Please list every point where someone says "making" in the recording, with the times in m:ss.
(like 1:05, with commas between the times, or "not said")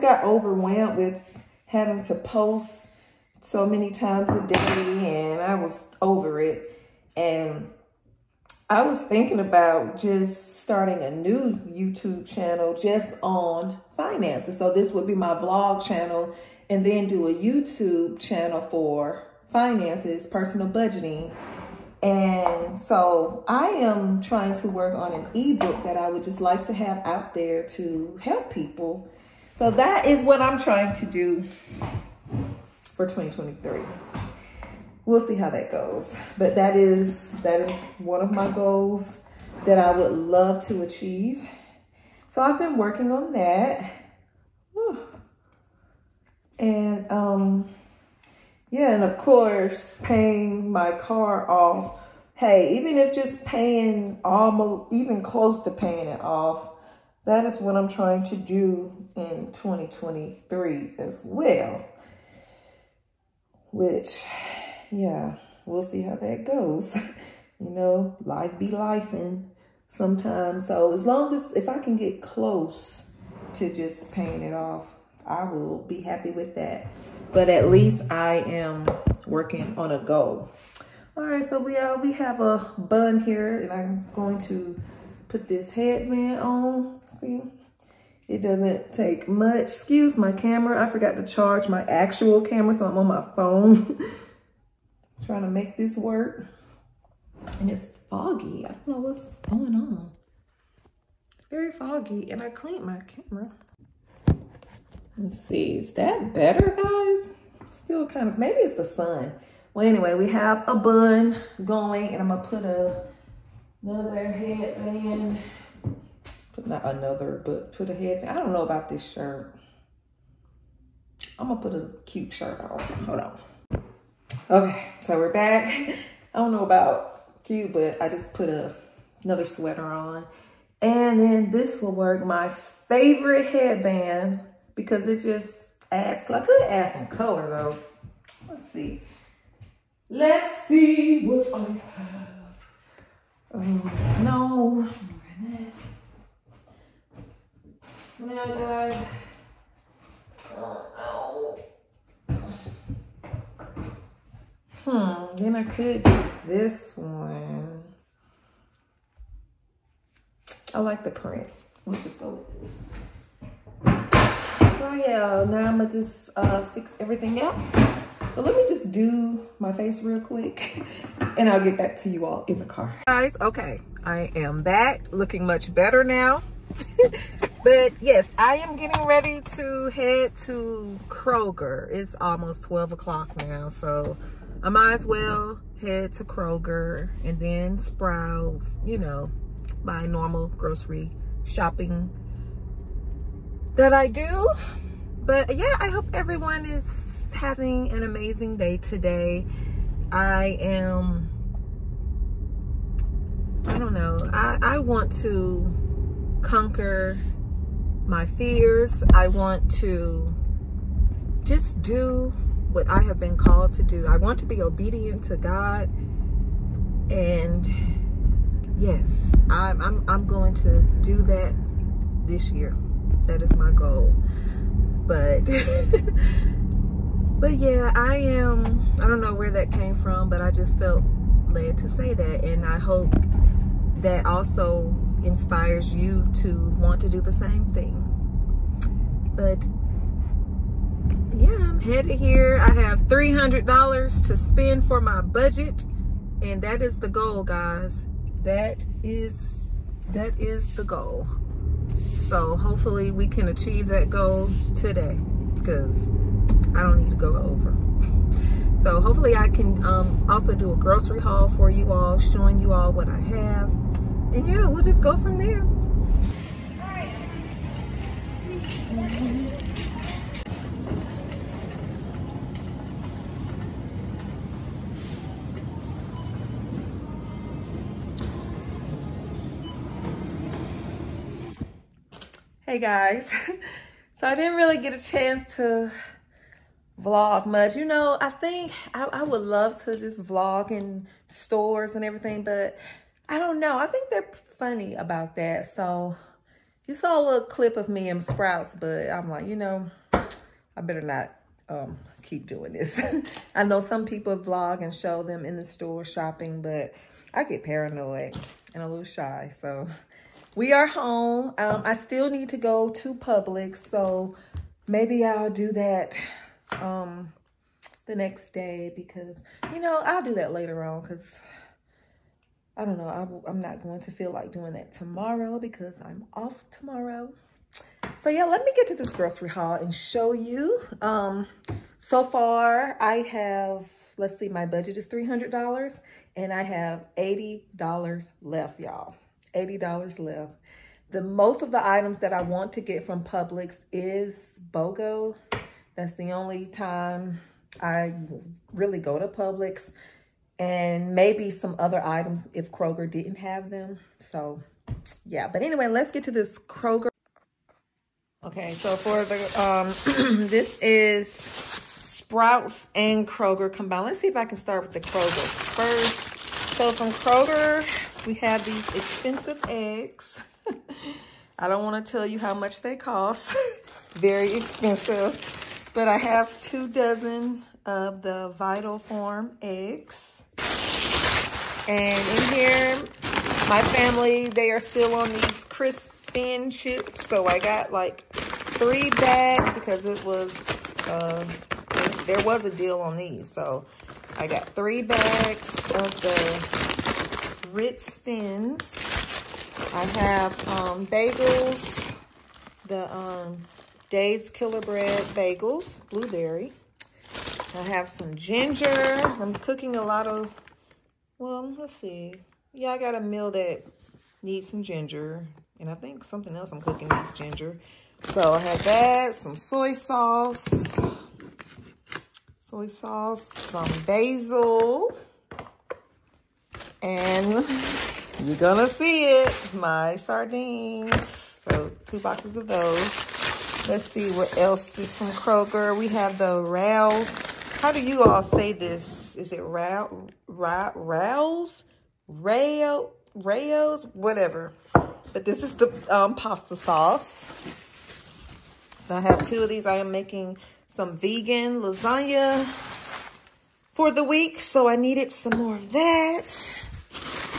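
7:30.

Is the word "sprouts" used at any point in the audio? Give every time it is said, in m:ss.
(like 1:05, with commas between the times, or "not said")
3:07, 4:58, 6:01.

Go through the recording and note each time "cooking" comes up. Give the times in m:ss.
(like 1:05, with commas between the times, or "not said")
6:49, 6:56.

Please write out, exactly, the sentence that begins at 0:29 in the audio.
So that is what I'm trying to do for 2023.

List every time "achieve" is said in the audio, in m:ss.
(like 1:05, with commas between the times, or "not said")
0:40, 4:13.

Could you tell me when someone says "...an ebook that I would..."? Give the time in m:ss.
0:25.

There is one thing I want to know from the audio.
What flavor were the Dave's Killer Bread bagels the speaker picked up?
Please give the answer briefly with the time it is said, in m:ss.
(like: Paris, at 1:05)
Blueberry, at 6:46.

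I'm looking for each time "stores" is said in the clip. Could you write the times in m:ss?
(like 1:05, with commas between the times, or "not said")
4:51, 5:05.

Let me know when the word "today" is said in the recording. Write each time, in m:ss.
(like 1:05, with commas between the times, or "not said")
3:18, 4:14.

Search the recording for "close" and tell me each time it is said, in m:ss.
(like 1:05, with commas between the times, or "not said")
0:55, 1:12.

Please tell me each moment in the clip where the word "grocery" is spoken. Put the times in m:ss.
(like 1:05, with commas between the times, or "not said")
3:10, 4:20, 5:29.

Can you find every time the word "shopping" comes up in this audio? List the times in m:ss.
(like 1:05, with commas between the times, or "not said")
3:11, 5:06.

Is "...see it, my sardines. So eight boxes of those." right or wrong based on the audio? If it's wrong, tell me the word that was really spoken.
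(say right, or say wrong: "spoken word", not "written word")
wrong: "two", not "eight".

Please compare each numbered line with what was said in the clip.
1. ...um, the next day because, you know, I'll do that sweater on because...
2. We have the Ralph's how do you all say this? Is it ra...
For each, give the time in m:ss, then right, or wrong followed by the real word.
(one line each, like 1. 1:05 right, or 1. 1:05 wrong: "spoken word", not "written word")
1. 5:16 wrong: "later", not "sweater"
2. 7:15 right.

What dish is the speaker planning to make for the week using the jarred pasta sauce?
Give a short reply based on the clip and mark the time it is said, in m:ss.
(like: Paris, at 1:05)
Vegan lasagna, at 7:31.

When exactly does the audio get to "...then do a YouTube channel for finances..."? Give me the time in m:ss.
0:16.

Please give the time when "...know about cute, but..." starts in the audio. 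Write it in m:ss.
2:06.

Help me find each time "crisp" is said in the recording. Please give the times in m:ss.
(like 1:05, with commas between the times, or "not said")
6:25.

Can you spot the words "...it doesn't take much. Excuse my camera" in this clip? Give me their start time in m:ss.
1:28.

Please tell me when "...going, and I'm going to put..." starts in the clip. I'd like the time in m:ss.
1:51.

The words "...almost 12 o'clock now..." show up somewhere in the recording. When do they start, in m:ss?
3:02.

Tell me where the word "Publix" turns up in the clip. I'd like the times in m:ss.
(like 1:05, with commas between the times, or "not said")
5:13, 5:43, 5:49.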